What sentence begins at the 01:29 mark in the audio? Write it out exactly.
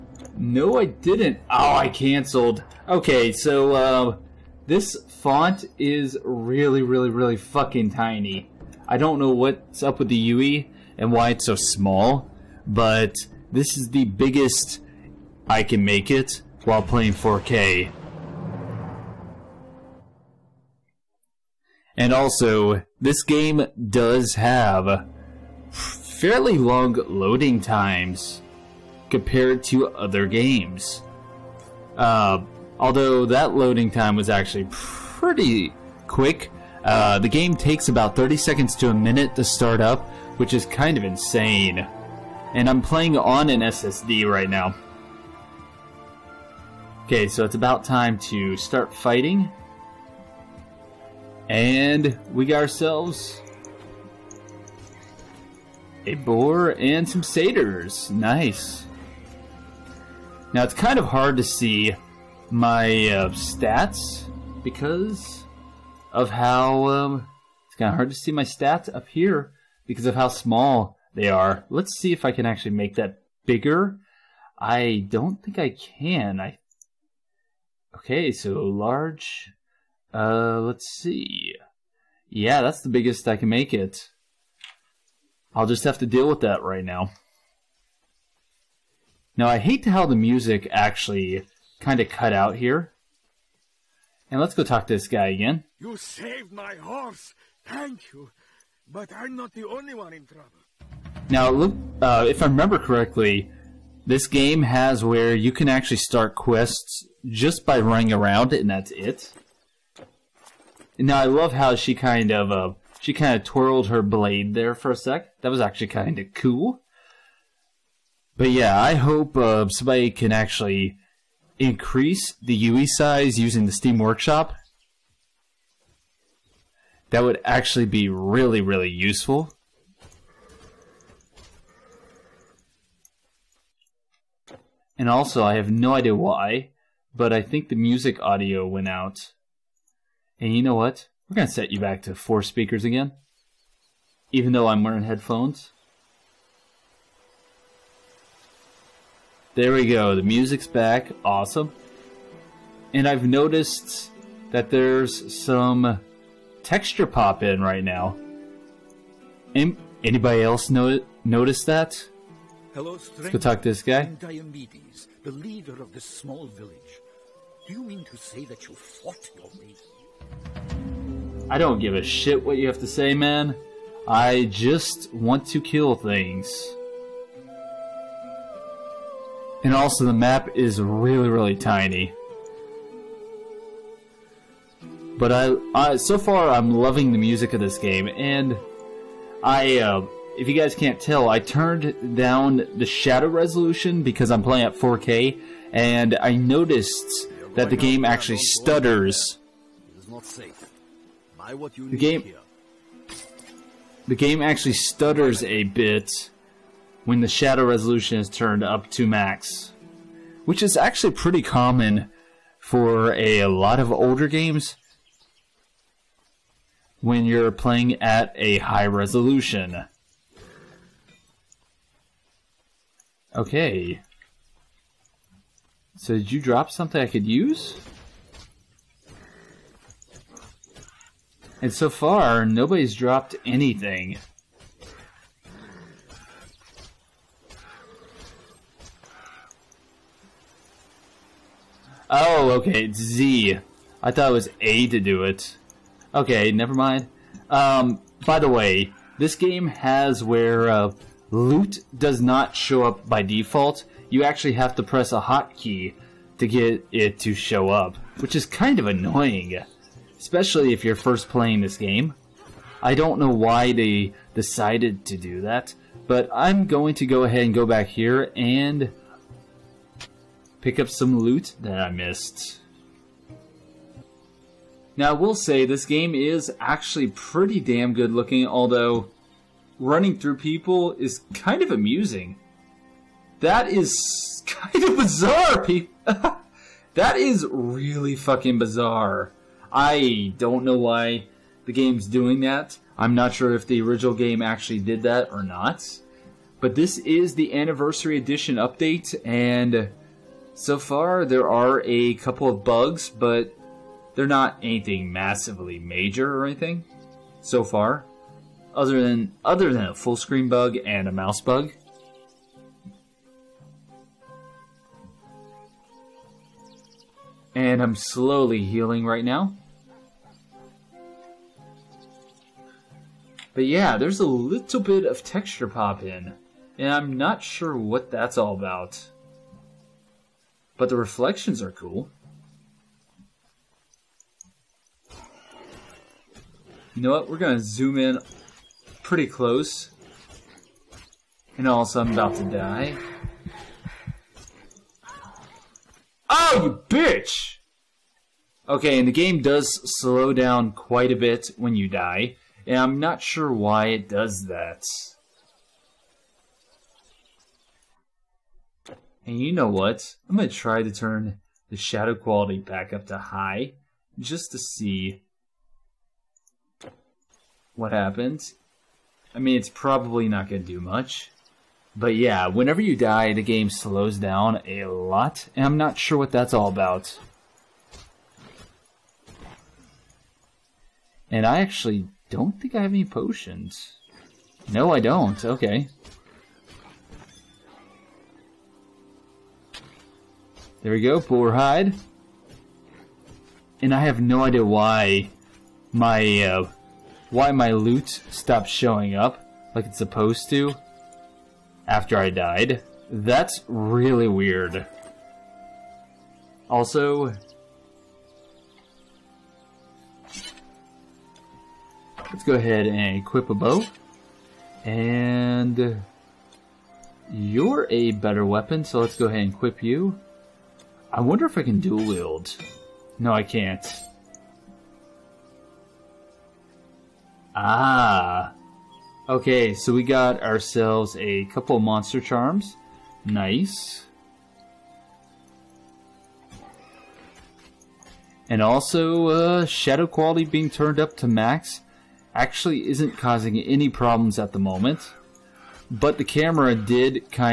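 Now, I hate how the music actually kind of cut out here.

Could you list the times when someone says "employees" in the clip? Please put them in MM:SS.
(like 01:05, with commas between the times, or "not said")
not said.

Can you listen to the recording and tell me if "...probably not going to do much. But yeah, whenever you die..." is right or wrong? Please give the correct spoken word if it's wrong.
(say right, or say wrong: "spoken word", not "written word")
right.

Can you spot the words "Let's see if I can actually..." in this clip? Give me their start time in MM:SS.
01:11.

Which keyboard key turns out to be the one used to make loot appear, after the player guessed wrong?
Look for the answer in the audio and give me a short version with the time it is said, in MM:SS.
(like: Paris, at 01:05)
Z, at 04:02.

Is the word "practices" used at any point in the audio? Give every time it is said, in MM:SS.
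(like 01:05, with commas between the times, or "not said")
not said.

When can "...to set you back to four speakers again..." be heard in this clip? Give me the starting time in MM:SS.
02:21.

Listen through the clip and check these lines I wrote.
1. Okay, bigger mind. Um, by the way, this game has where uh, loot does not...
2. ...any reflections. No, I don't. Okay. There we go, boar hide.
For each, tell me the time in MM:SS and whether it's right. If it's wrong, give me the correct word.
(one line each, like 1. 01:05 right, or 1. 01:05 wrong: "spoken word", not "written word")
1. 04:06 wrong: "never", not "bigger"
2. 06:22 wrong: "potions", not "reflections".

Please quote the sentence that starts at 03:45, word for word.
So did you drop something I could use?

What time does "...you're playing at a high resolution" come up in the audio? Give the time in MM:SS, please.
03:37.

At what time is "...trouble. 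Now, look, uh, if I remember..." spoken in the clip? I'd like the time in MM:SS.
01:40.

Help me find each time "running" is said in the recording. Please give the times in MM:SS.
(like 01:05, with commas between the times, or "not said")
01:47, 04:39.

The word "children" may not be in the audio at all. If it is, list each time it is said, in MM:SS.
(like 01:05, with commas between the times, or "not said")
not said.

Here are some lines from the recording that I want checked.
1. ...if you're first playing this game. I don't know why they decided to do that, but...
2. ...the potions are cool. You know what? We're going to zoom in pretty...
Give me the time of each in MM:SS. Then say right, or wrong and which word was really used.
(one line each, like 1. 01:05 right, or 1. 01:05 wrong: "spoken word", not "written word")
1. 04:20 right
2. 05:30 wrong: "reflections", not "potions".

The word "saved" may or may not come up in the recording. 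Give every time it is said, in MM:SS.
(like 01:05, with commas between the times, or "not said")
01:35.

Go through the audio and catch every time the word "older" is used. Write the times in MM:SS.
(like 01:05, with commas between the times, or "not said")
03:33.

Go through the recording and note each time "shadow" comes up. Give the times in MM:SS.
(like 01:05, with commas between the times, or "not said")
03:12, 03:27, 06:01, 07:19.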